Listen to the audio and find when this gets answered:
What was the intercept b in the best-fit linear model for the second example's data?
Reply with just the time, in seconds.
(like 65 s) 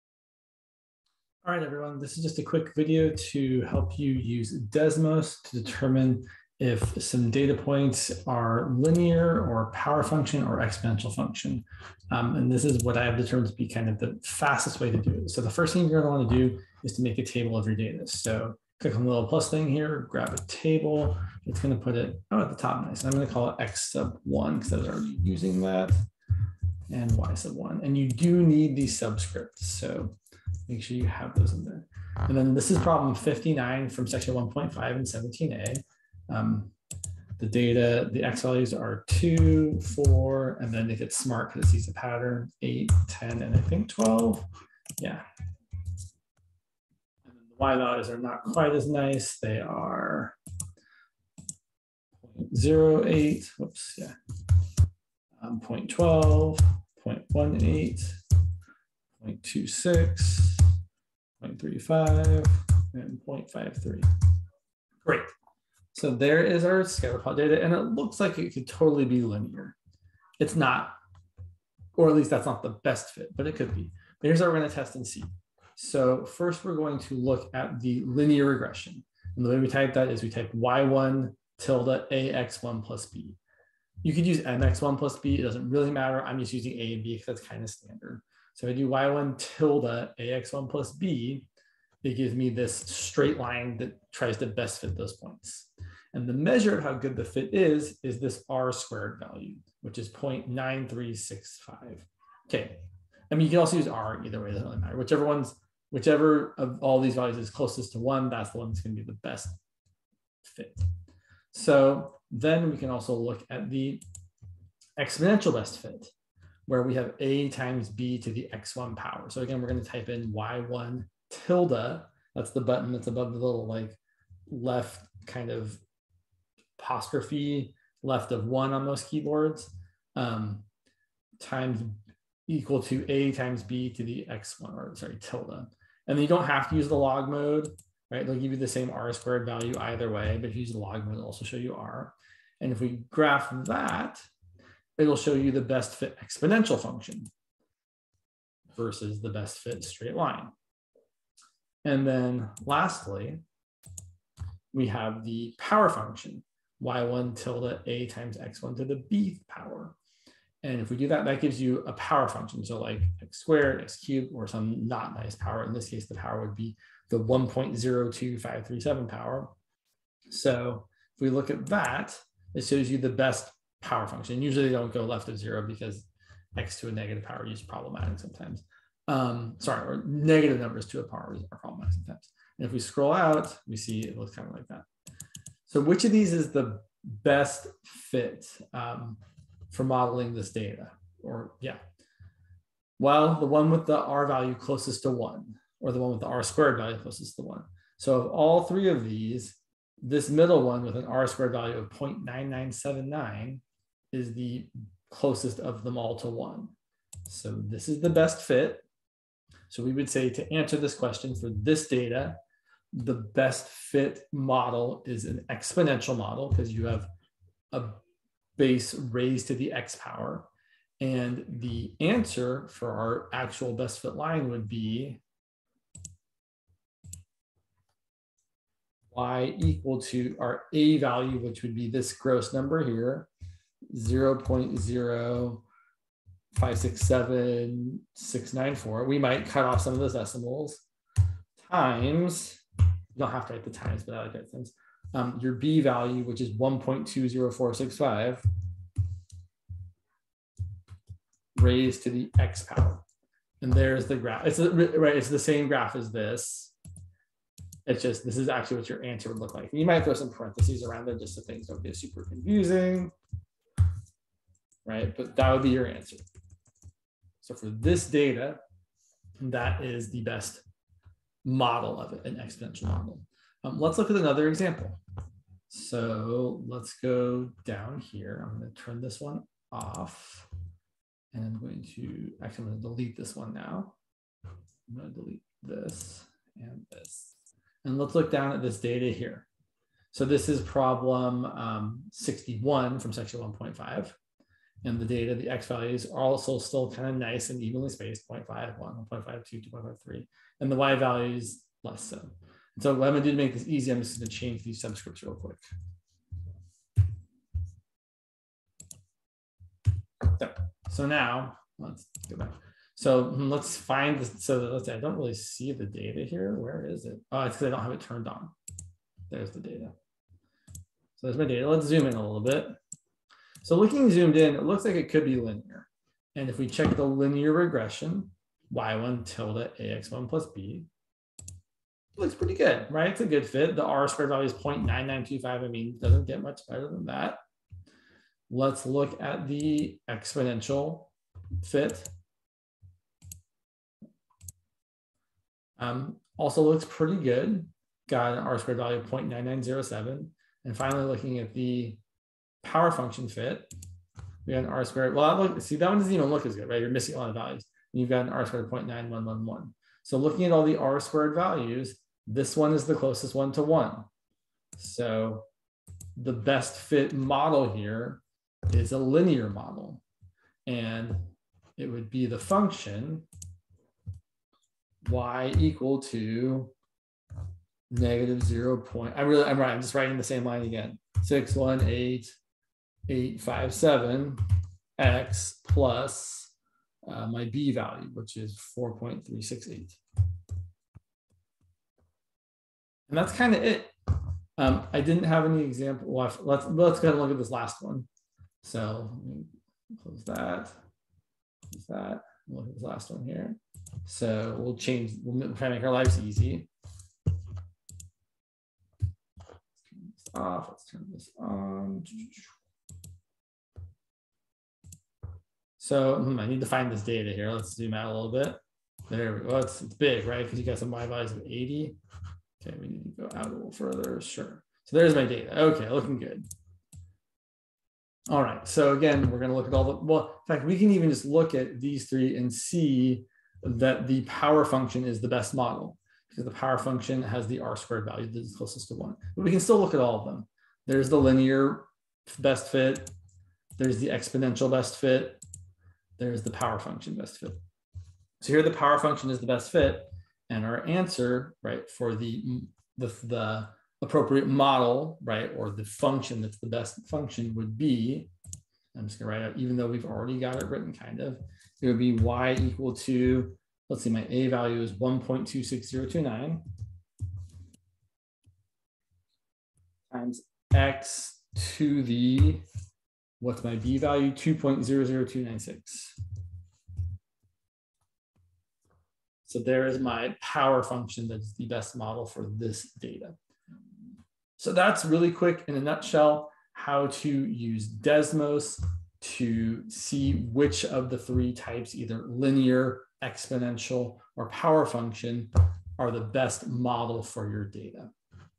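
388 s.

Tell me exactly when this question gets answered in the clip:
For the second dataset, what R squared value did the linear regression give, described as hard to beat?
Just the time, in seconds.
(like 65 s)
334 s.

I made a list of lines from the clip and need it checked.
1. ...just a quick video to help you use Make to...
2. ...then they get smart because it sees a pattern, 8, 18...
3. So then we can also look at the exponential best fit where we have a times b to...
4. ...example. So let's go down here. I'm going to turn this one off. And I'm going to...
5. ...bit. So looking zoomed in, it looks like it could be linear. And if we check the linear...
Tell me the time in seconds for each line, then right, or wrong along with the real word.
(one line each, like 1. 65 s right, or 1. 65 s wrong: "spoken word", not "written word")
1. 2 s wrong: "Desmos", not "Make"
2. 40 s wrong: "10", not "18"
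3. 111 s right
4. 274 s right
5. 322 s right.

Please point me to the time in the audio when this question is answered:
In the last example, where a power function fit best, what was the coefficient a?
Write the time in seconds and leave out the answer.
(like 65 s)
464 s.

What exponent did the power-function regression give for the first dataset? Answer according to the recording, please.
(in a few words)
1.02537.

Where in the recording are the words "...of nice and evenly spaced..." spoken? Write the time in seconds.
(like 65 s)
297 s.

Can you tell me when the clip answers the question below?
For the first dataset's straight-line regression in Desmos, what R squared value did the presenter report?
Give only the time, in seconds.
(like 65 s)
100 s.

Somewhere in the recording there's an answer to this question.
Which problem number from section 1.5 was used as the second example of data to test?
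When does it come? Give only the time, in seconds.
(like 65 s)
292 s.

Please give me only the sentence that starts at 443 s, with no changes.
There's the exponential best fit there's the power function best fit.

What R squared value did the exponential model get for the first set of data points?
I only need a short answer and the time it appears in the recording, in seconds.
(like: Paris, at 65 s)
0.9979, at 201 s.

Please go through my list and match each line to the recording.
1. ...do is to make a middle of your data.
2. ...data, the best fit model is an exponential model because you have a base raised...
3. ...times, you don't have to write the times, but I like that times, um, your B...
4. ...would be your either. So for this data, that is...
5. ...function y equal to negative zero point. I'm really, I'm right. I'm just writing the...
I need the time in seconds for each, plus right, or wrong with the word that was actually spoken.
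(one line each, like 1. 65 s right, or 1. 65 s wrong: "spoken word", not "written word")
1. 16 s wrong: "table", not "middle"
2. 211 s right
3. 241 s right
4. 265 s wrong: "answer", not "either"
5. 372 s right.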